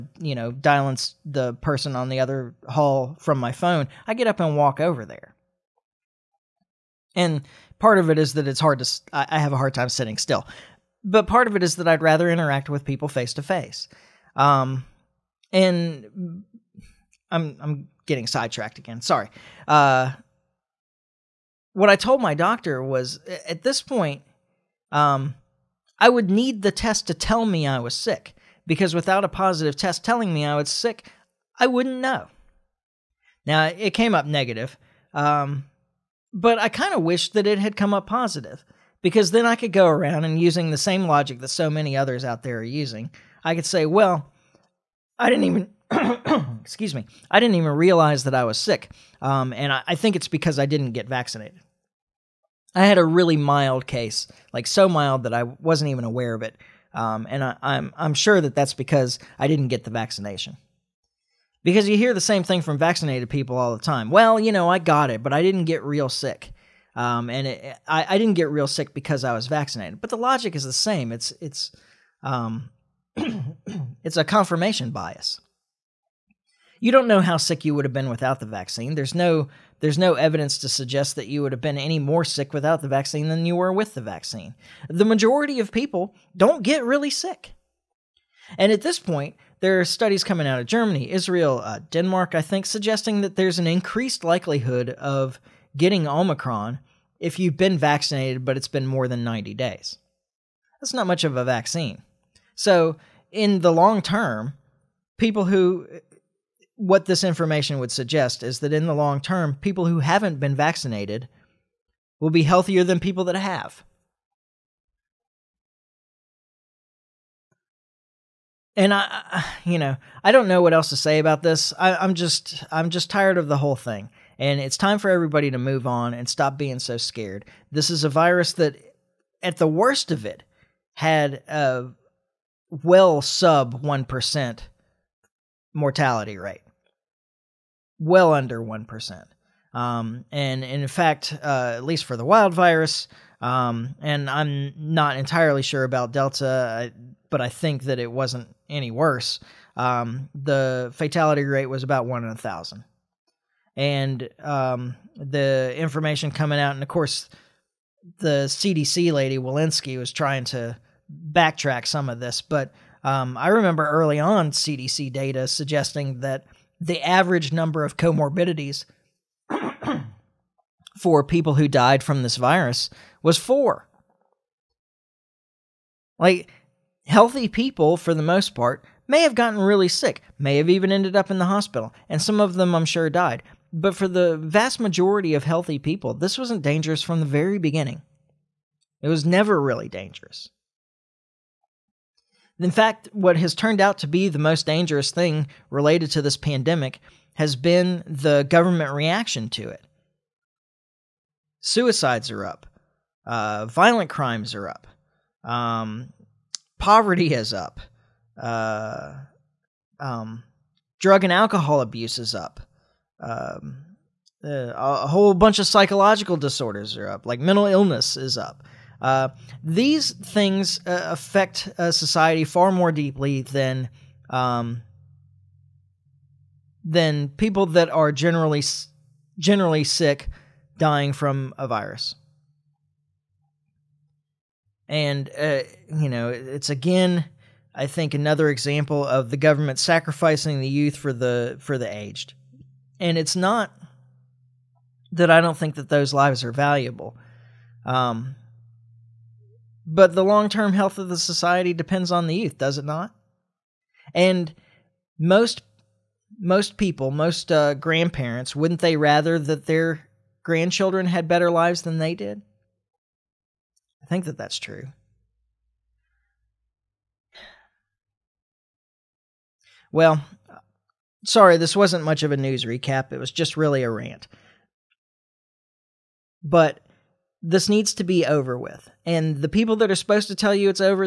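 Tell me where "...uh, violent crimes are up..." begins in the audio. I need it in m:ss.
3:23.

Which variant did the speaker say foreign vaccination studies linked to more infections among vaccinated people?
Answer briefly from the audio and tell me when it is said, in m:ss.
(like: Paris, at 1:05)
Omicron, at 1:36.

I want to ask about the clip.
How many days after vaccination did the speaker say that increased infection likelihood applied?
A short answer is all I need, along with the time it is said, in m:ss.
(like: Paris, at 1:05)
90, at 1:39.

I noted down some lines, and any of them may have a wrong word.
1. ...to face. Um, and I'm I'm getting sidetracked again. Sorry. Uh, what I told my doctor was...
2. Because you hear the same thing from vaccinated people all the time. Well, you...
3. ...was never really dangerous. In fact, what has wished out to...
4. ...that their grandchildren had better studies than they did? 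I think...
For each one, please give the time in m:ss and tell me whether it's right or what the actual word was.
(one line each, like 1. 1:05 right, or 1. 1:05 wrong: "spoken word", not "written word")
1. 0:13 right
2. 1:01 right
3. 3:09 wrong: "turned", not "wished"
4. 4:19 wrong: "lives", not "studies".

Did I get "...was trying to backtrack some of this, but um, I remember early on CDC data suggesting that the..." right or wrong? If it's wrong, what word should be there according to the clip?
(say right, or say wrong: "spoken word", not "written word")
right.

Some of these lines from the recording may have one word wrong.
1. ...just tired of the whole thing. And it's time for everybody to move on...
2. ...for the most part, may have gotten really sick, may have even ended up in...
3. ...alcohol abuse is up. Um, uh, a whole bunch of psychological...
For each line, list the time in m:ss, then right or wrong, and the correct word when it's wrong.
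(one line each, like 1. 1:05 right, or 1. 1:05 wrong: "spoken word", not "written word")
1. 2:02 right
2. 2:57 right
3. 3:31 right.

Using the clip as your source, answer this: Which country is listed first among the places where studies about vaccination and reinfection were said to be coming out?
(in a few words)
Germany.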